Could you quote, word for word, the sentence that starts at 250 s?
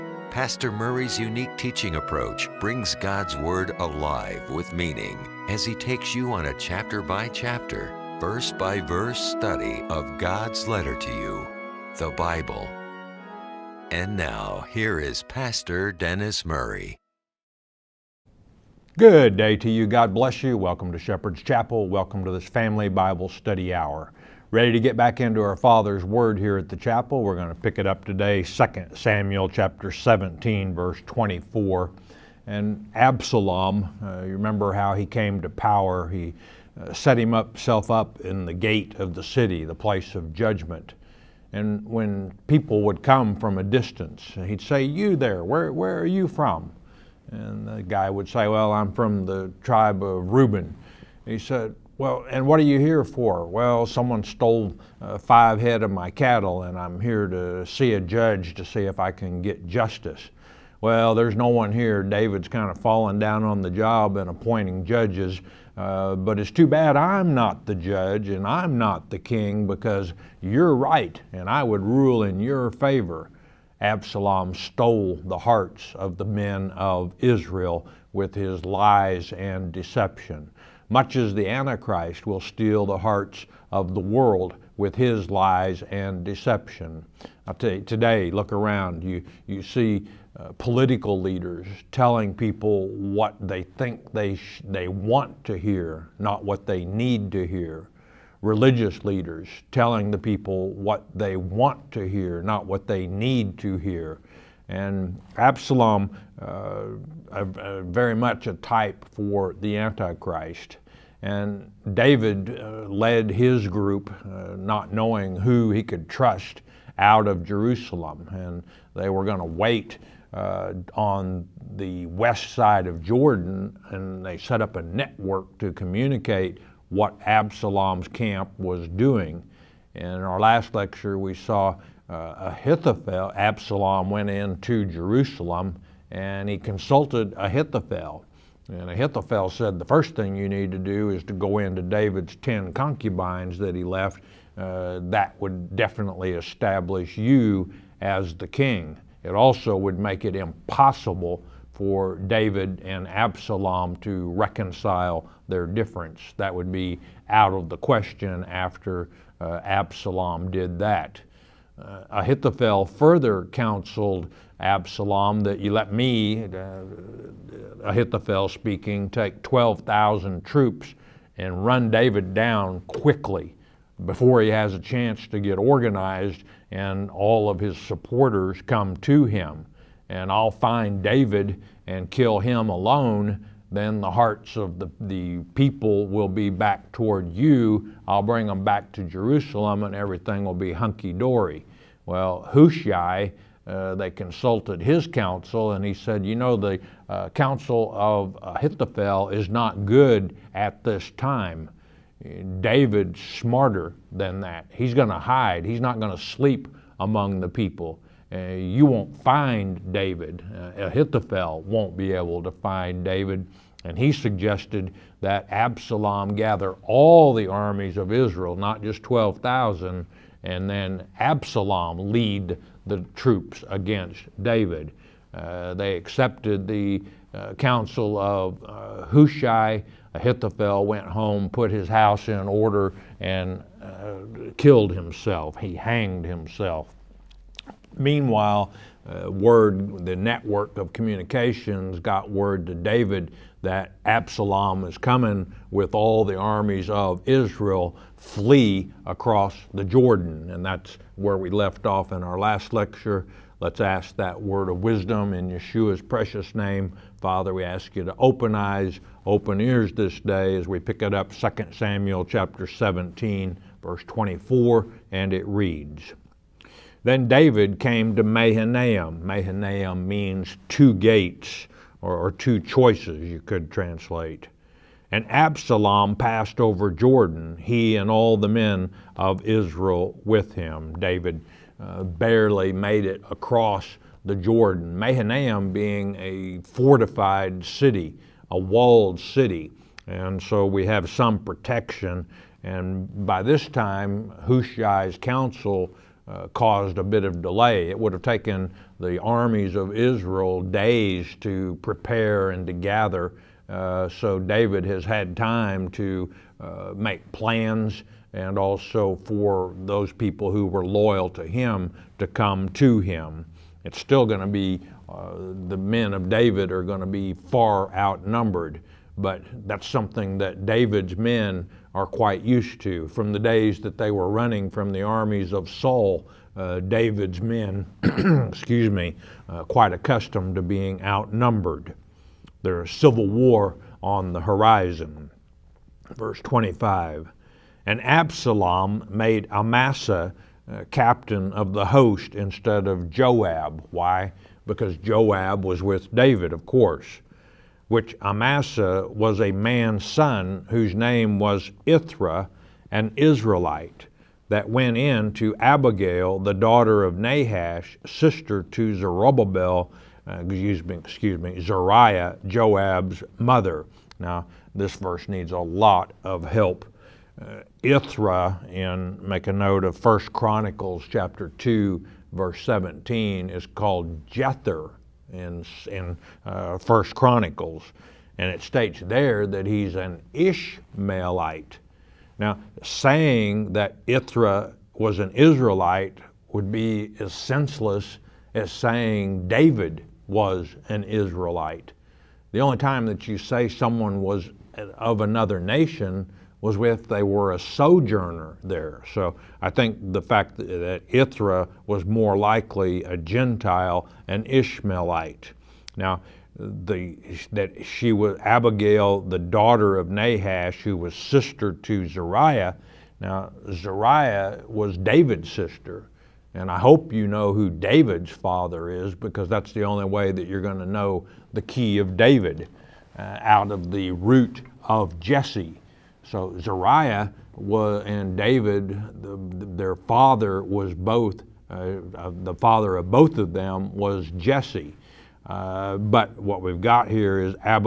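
And that's where we left off in our last lecture.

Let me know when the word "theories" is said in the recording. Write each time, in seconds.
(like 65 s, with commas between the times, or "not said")
not said.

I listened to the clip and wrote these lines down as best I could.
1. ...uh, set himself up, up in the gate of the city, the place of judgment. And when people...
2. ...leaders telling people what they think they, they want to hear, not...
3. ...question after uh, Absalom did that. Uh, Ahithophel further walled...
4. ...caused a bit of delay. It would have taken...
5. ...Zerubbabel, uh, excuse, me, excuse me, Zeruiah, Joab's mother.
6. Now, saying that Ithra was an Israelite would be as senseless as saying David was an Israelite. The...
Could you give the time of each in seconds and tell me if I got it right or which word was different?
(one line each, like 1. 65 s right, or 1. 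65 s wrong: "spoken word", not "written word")
1. 36 s right
2. 91 s right
3. 157 s wrong: "counseled", not "walled"
4. 296 s right
5. 358 s right
6. 382 s right.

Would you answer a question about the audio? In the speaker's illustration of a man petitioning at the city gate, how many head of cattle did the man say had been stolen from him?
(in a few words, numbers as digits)
5.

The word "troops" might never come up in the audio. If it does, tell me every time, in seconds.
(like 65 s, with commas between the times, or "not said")
170 s, 223 s.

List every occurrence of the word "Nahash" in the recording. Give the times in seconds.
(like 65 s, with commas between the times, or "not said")
357 s, 410 s.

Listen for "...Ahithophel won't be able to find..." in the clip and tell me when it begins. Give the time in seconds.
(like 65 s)
210 s.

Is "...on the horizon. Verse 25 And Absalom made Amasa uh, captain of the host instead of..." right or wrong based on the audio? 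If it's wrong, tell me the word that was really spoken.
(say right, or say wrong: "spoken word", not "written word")
right.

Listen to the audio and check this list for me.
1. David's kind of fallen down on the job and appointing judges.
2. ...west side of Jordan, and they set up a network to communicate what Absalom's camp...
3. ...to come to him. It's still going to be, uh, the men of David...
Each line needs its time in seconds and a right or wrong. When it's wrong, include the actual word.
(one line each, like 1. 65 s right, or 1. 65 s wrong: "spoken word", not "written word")
1. 62 s right
2. 122 s right
3. 312 s right.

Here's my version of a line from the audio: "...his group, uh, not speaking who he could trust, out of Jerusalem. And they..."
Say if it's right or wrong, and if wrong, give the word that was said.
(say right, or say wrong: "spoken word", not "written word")
wrong: "knowing", not "speaking".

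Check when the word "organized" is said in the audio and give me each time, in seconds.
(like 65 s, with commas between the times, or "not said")
175 s.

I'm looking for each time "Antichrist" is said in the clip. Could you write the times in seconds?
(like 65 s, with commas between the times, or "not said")
81 s, 109 s.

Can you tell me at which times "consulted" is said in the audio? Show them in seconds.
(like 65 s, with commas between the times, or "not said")
136 s, 194 s.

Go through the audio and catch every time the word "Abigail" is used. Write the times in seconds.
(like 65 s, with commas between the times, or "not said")
355 s, 408 s.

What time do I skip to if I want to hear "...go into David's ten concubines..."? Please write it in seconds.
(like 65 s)
141 s.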